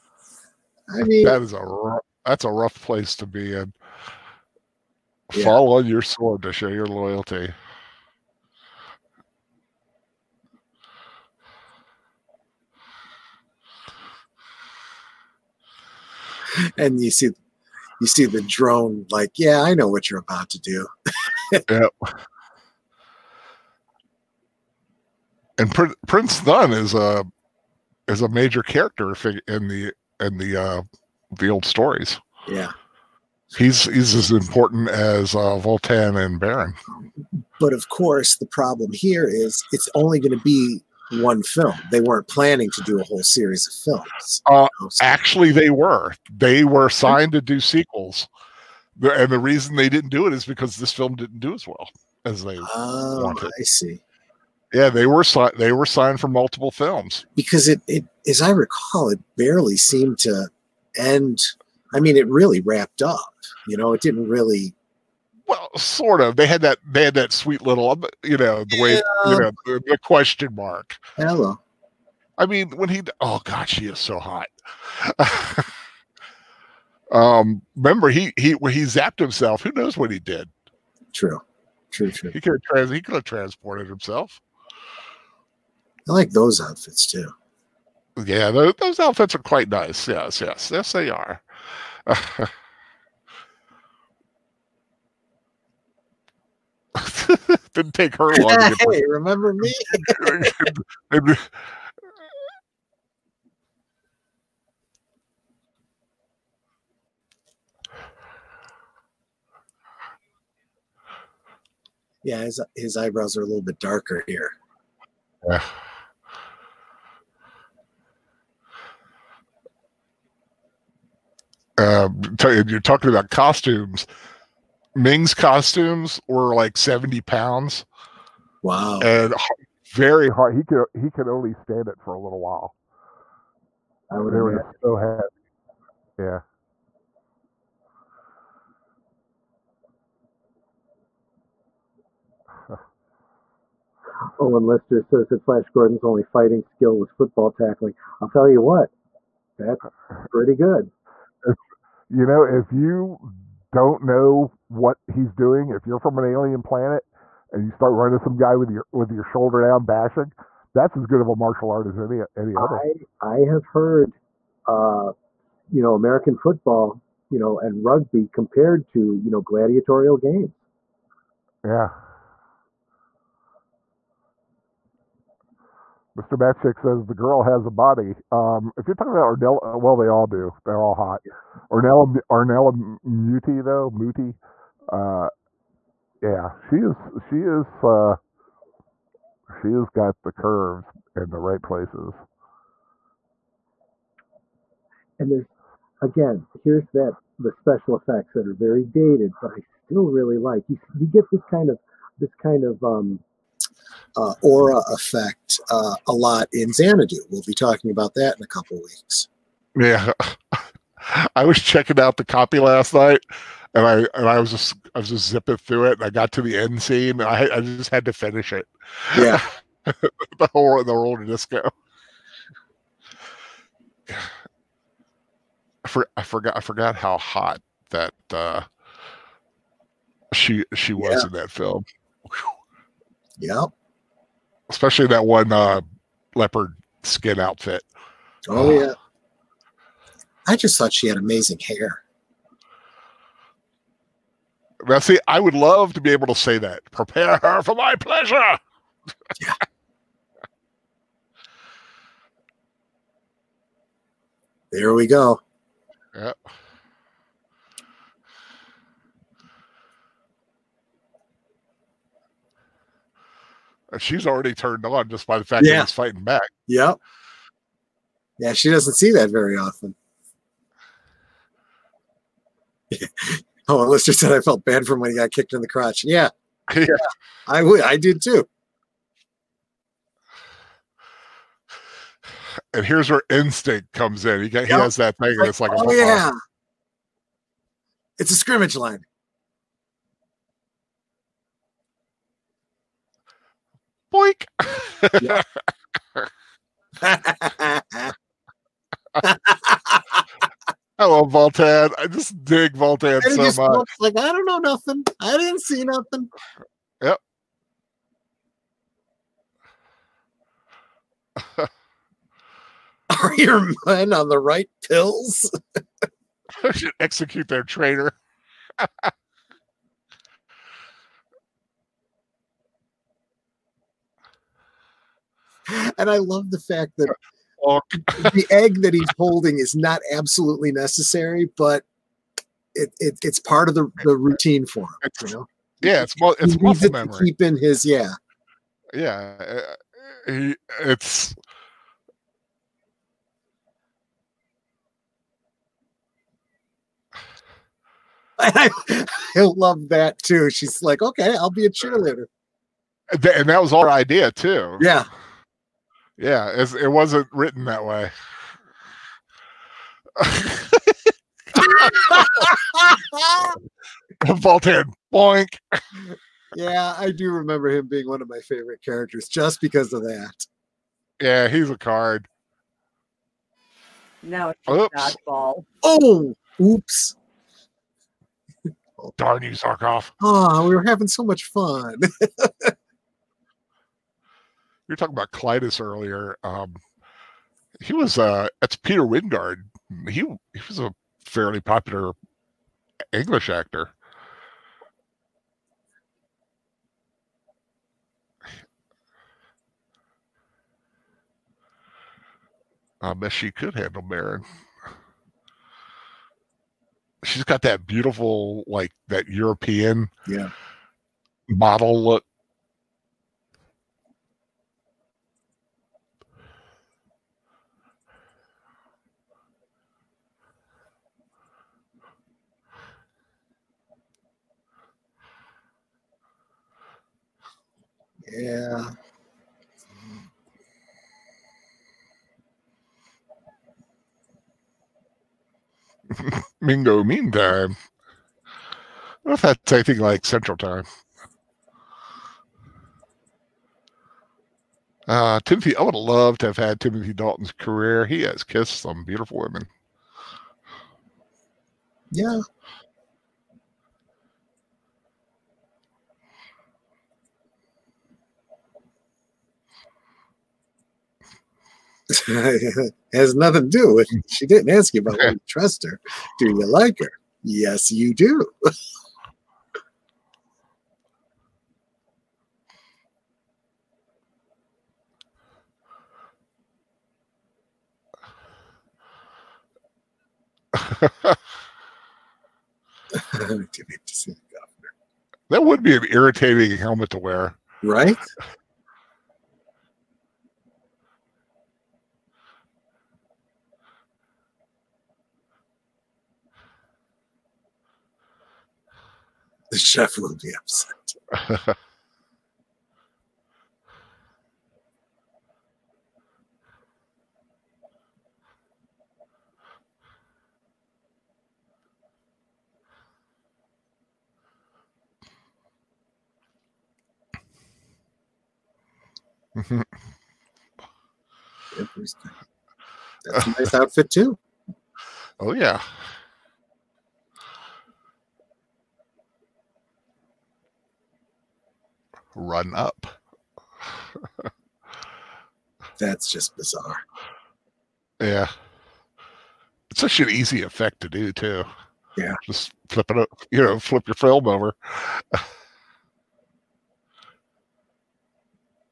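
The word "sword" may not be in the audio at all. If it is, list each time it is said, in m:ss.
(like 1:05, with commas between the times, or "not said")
0:06.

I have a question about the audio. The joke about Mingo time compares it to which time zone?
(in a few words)
Central Time.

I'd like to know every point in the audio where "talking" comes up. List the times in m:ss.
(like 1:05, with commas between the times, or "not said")
2:02, 2:58, 3:27, 6:24.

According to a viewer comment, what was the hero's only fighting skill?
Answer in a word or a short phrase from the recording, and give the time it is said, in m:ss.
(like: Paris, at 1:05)
Football tackling, at 2:27.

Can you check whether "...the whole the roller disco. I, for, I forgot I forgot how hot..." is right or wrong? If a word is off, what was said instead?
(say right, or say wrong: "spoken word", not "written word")
right.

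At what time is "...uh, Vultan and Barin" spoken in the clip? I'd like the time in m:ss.
0:35.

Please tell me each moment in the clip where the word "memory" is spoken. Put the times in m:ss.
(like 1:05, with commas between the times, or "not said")
5:36.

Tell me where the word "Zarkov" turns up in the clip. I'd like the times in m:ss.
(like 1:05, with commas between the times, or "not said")
6:19.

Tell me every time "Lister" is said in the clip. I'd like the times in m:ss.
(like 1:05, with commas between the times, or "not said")
2:24, 4:33.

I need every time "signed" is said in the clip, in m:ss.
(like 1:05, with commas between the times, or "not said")
0:46, 0:55.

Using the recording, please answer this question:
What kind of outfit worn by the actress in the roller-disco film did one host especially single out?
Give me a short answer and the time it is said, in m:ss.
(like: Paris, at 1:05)
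Leopard skin, at 3:56.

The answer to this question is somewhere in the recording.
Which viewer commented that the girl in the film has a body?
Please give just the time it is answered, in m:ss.
2:56.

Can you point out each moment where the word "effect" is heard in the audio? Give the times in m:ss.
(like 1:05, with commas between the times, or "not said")
3:17, 3:24, 9:00.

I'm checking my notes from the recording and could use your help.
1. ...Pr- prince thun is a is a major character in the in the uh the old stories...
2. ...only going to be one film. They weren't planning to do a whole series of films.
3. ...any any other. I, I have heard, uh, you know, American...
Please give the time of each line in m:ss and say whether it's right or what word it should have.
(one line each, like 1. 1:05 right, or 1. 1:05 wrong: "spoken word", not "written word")
1. 0:25 right
2. 0:39 right
3. 2:41 right.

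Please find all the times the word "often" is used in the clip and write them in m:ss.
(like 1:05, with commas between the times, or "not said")
4:29.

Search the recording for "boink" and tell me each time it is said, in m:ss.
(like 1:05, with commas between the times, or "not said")
4:54, 6:05.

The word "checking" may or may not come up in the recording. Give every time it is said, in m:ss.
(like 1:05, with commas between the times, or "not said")
3:31.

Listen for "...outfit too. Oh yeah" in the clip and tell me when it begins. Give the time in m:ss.
8:43.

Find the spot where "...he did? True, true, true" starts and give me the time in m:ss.
1:20.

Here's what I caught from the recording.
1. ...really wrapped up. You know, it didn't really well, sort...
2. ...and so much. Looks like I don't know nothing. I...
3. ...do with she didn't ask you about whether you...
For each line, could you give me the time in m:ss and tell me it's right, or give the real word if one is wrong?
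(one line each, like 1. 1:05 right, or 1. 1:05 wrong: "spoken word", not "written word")
1. 1:02 right
2. 5:03 right
3. 7:43 right.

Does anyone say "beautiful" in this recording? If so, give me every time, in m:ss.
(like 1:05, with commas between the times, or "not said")
6:47, 7:29.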